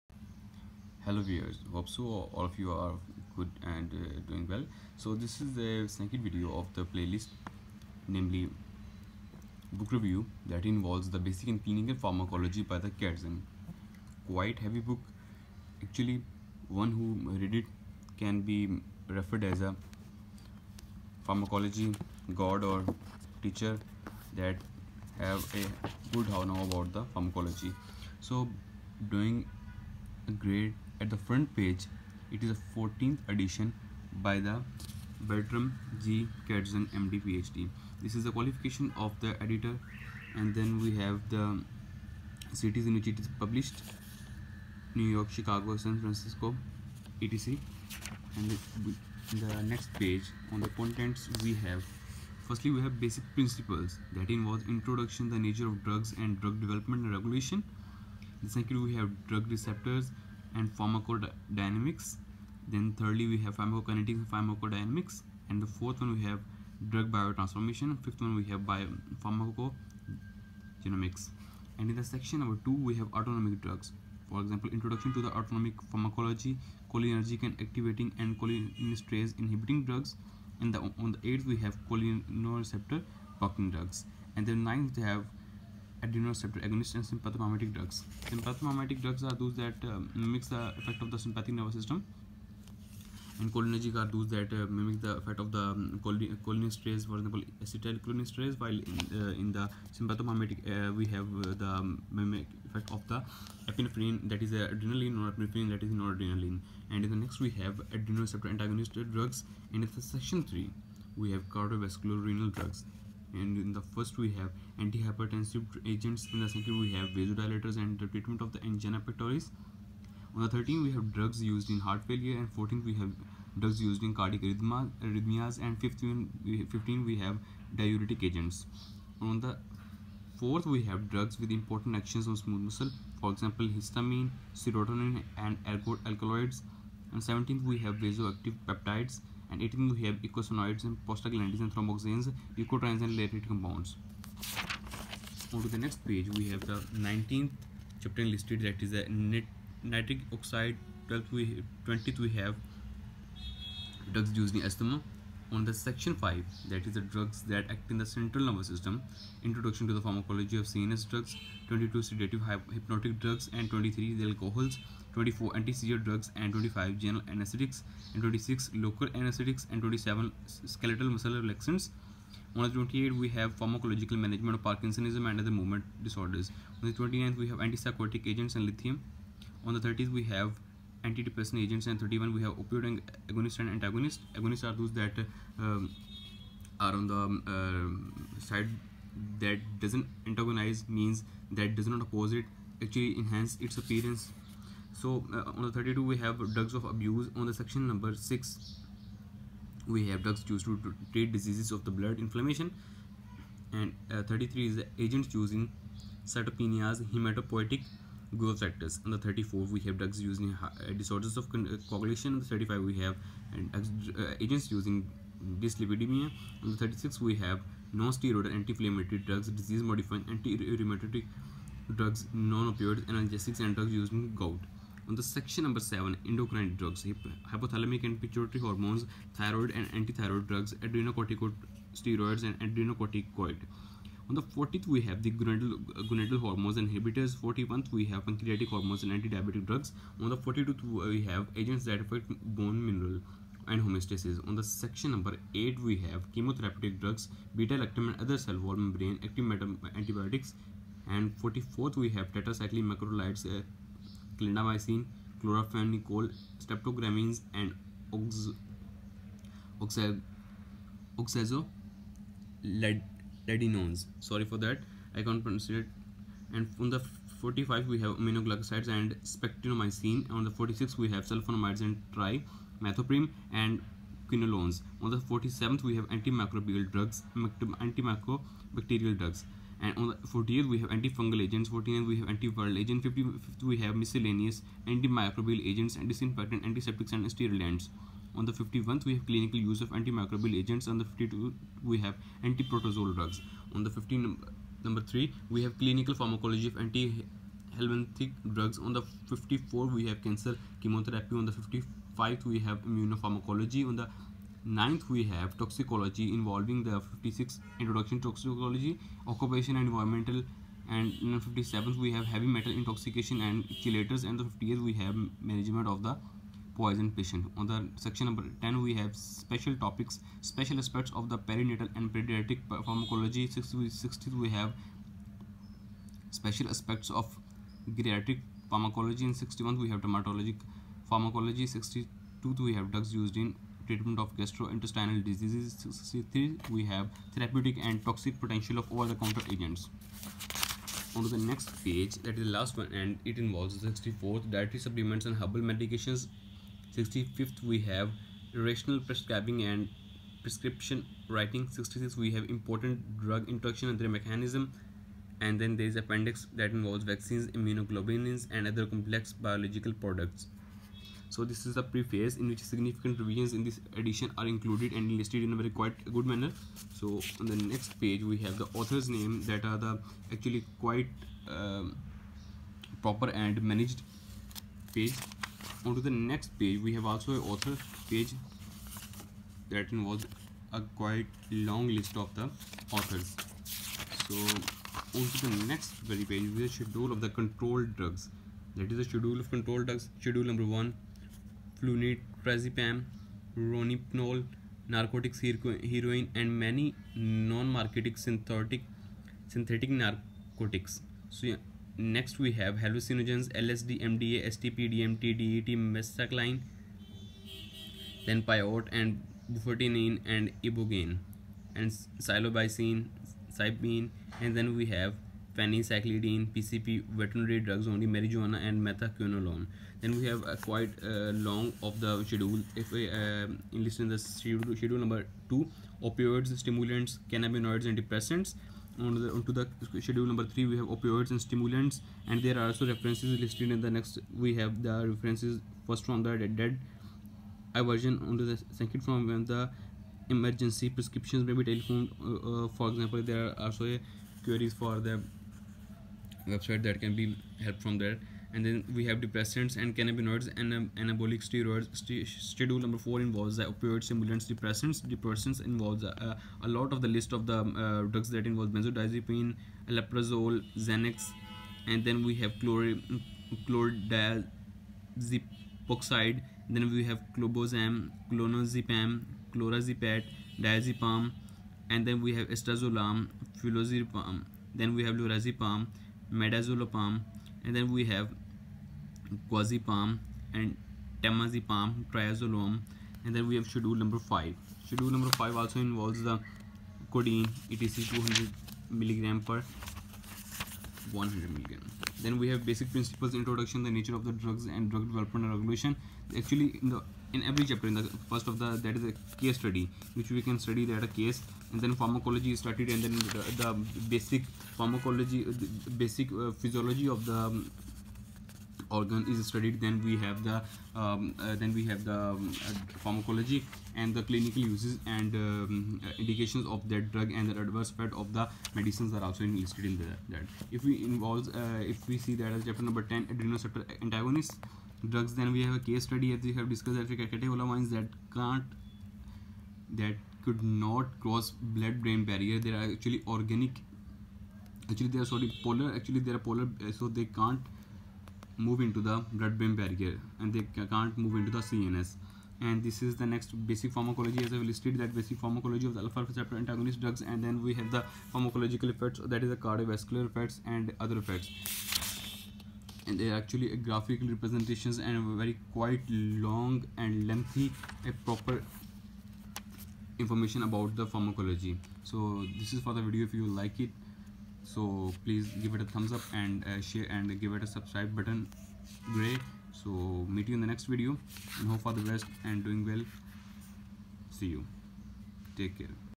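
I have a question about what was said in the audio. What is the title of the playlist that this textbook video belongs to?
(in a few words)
Book review.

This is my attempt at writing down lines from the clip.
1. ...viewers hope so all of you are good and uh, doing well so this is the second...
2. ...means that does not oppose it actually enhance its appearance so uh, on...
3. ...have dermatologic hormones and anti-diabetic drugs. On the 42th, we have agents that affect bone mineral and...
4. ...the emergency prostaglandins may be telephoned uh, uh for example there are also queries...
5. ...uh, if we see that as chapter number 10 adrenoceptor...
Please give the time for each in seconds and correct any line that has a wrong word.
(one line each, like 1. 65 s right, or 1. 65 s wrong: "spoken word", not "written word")
1. 1 s right
2. 190 s right
3. 238 s wrong: "pancreatic", not "dermatologic"
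4. 439 s wrong: "prescriptions", not "prostaglandins"
5. 521 s right.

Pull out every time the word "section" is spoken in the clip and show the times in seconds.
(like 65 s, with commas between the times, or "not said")
72 s, 110 s, 155 s, 197 s, 225 s, 244 s, 317 s.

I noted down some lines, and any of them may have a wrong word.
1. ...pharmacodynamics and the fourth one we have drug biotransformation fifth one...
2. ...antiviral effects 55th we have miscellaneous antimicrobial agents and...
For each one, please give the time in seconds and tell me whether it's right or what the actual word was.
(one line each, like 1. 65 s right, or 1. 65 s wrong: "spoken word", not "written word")
1. 64 s right
2. 282 s wrong: "agents", not "effects".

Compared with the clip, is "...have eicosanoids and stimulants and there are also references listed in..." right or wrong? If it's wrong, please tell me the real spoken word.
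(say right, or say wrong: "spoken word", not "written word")
wrong: "opioids", not "eicosanoids".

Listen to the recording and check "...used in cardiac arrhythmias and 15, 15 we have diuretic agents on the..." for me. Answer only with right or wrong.
right.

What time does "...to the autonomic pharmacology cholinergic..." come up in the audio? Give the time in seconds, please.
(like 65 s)
75 s.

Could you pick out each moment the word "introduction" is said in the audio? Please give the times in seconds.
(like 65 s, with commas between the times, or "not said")
54 s, 74 s, 159 s, 307 s, 493 s.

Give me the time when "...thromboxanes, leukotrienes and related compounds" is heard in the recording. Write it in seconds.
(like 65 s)
141 s.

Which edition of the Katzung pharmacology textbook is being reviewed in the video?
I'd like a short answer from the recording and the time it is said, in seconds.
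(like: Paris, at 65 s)
14th, at 32 s.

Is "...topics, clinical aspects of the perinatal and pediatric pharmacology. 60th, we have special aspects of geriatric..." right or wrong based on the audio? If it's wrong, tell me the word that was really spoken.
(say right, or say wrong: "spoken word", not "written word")
wrong: "special", not "clinical".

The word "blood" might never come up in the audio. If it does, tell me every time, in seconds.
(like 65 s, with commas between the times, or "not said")
201 s, 531 s, 539 s.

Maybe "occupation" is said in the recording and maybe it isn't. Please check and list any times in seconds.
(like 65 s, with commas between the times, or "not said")
309 s.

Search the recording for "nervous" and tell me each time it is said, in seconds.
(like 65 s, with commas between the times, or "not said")
91 s, 158 s.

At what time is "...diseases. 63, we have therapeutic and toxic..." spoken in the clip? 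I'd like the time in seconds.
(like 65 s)
335 s.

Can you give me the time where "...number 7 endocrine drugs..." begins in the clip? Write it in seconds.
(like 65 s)
225 s.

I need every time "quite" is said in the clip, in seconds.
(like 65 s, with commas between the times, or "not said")
14 s, 365 s, 370 s, 380 s, 420 s, 555 s.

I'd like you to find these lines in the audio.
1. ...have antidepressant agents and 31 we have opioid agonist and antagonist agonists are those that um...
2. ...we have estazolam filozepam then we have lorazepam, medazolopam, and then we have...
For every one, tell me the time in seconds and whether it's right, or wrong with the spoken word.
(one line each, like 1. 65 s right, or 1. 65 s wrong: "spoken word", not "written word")
1. 180 s right
2. 472 s right.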